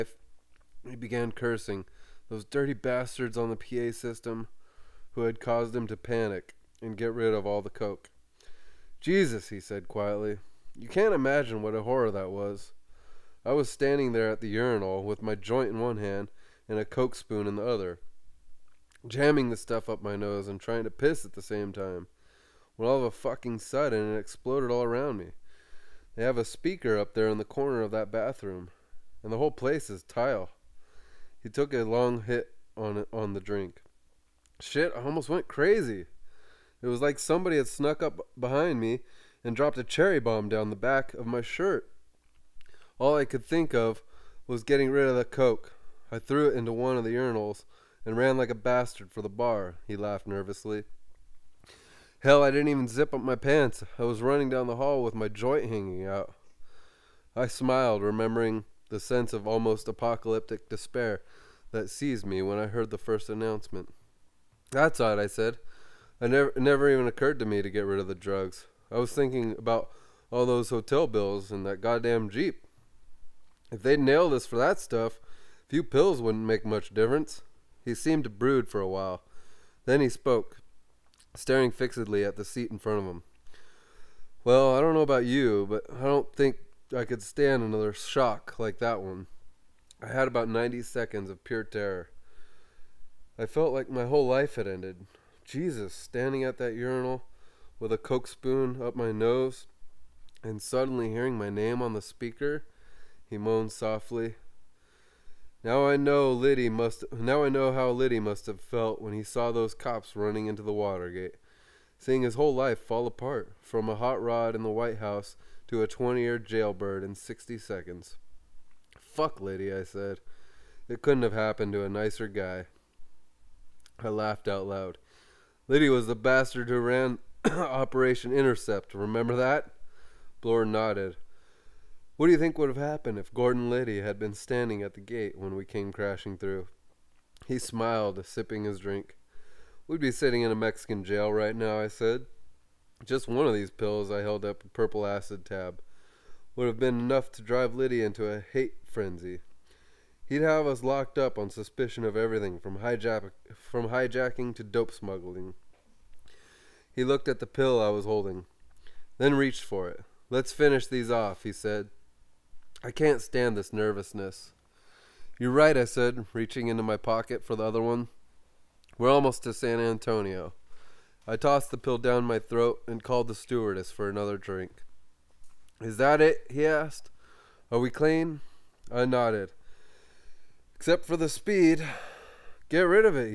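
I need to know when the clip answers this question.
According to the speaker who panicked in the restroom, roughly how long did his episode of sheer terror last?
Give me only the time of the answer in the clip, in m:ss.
1:30.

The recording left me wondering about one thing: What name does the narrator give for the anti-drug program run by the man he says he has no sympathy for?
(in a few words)
Operation Intercept.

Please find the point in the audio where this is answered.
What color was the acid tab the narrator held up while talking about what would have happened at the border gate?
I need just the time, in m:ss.
2:24.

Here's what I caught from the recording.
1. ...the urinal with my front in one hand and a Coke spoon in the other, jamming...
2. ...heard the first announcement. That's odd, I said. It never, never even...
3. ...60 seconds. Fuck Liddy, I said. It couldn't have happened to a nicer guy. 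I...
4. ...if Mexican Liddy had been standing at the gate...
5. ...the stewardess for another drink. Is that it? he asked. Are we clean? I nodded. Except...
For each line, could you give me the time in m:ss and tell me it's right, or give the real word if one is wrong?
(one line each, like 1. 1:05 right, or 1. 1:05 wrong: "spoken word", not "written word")
1. 0:14 wrong: "joint", not "front"
2. 1:02 right
3. 1:57 right
4. 2:13 wrong: "Gordon", not "Mexican"
5. 2:53 right.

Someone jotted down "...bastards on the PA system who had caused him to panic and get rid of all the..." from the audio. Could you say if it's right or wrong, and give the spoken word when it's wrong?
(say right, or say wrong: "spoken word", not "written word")
right.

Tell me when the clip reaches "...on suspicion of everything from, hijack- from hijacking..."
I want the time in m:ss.
2:31.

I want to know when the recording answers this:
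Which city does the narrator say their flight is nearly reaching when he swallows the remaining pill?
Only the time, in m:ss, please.
2:49.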